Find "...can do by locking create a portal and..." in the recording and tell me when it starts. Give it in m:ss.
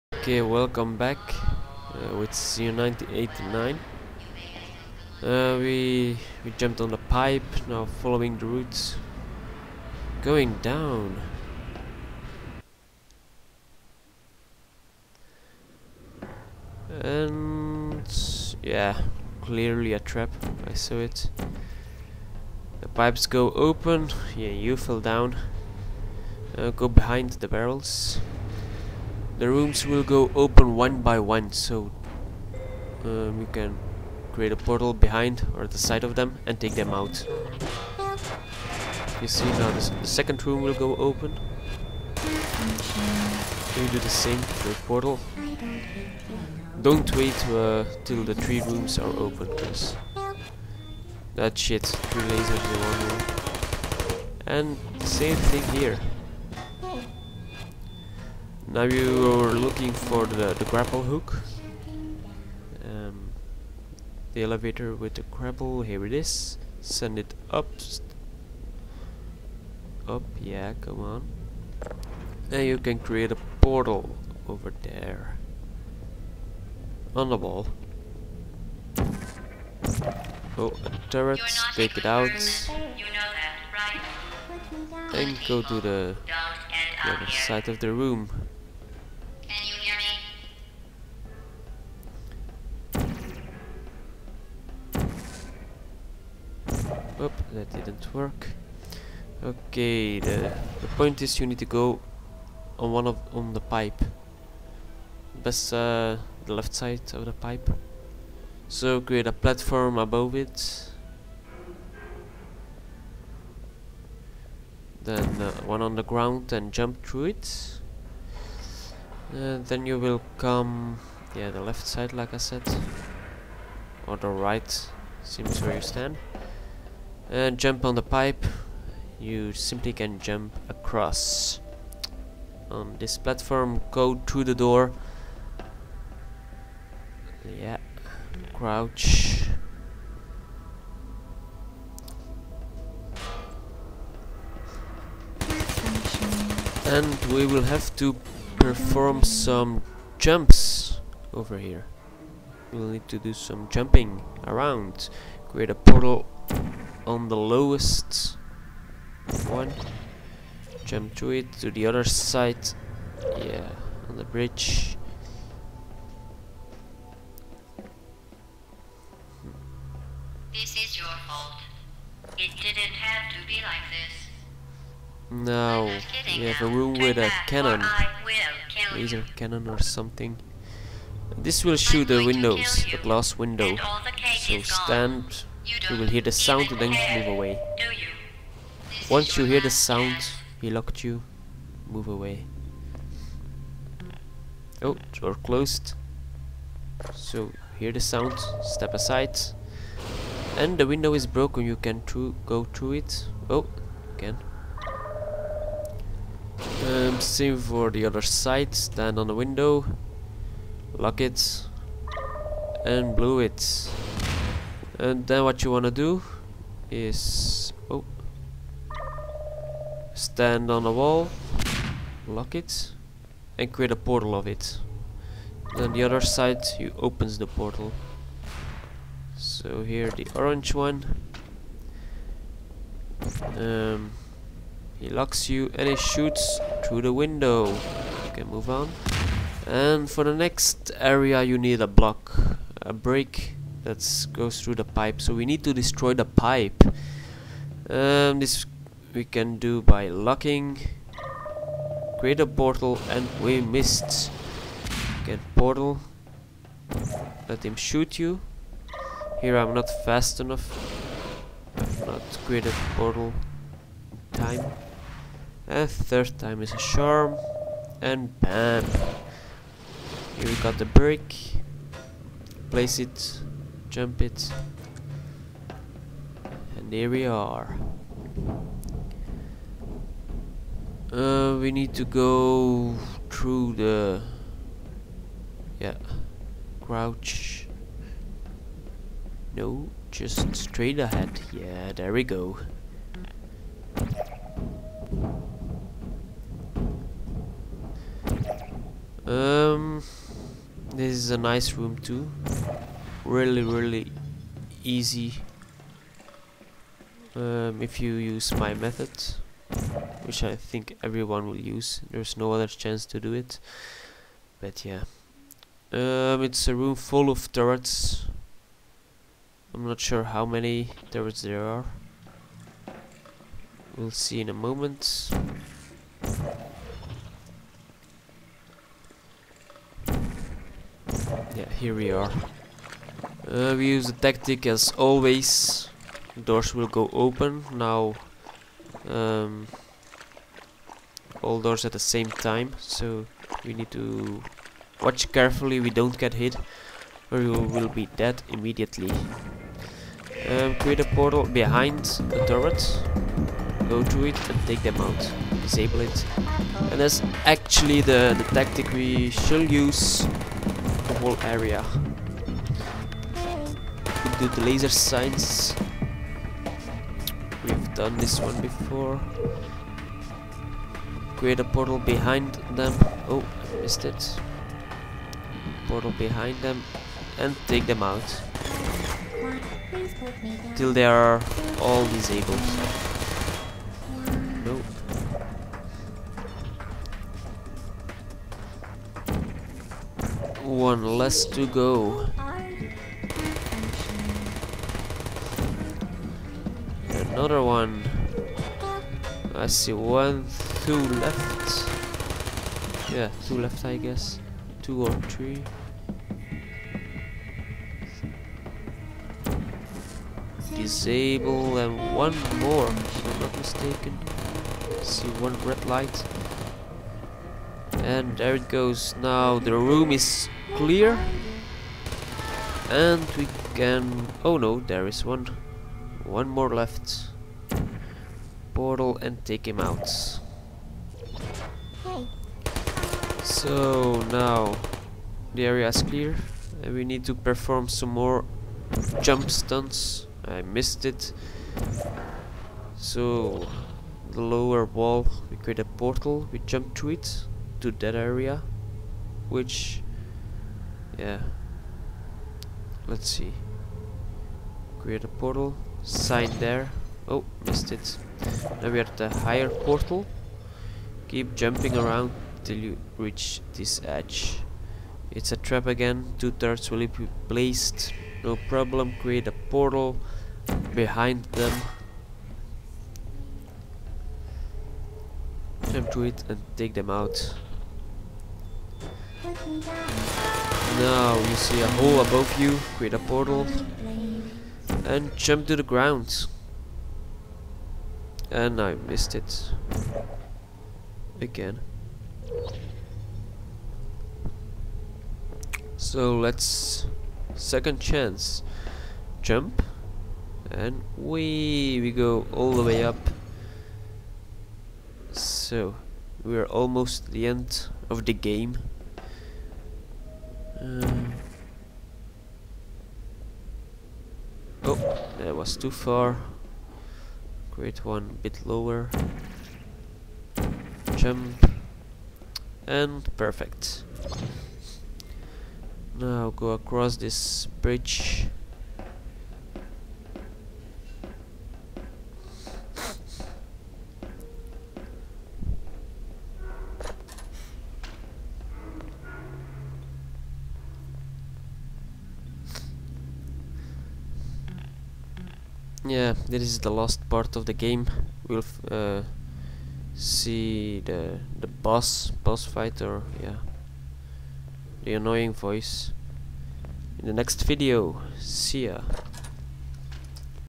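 4:09.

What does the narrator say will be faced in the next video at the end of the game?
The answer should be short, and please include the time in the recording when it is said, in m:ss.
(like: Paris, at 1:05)
the boss, at 9:12.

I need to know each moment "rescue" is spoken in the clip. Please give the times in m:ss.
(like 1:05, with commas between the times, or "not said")
not said.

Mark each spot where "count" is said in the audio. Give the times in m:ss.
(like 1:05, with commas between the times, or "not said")
not said.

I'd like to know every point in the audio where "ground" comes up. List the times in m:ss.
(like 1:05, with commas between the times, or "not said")
1:56, 8:05.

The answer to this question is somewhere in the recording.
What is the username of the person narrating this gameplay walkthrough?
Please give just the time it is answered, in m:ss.
0:02.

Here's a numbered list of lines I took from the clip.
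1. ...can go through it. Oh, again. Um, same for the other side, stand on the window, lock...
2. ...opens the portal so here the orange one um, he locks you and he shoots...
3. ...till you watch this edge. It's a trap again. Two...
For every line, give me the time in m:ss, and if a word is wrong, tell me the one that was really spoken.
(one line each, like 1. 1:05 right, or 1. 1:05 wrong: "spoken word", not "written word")
1. 3:21 right
2. 3:46 right
3. 7:42 wrong: "reach", not "watch".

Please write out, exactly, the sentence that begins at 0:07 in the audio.
Now following the roots, going down.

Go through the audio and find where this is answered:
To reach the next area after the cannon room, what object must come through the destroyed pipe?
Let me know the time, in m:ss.
4:02.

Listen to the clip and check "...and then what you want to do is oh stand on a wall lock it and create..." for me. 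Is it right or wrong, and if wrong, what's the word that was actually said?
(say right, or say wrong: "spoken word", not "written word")
right.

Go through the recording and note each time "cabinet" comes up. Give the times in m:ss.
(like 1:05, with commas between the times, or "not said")
not said.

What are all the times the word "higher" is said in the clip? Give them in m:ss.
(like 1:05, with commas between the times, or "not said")
7:39.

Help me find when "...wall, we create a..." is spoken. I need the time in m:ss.
7:24.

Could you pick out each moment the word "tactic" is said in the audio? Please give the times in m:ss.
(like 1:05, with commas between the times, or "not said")
5:34, 5:58.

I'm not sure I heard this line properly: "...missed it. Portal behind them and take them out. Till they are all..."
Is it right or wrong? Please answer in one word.
right.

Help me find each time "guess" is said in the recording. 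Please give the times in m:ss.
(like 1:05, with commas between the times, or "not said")
6:43.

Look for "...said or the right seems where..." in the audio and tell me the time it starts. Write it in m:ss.
2:02.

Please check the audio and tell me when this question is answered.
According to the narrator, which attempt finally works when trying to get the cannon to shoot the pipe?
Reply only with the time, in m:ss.
4:25.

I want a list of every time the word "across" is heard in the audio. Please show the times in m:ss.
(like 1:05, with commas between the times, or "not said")
2:10, 8:46.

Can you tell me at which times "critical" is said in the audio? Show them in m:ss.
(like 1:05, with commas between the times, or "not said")
not said.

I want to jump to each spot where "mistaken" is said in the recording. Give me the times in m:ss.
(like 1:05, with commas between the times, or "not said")
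6:53.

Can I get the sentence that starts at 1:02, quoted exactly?
Um, the elevator with the grapple, here it is.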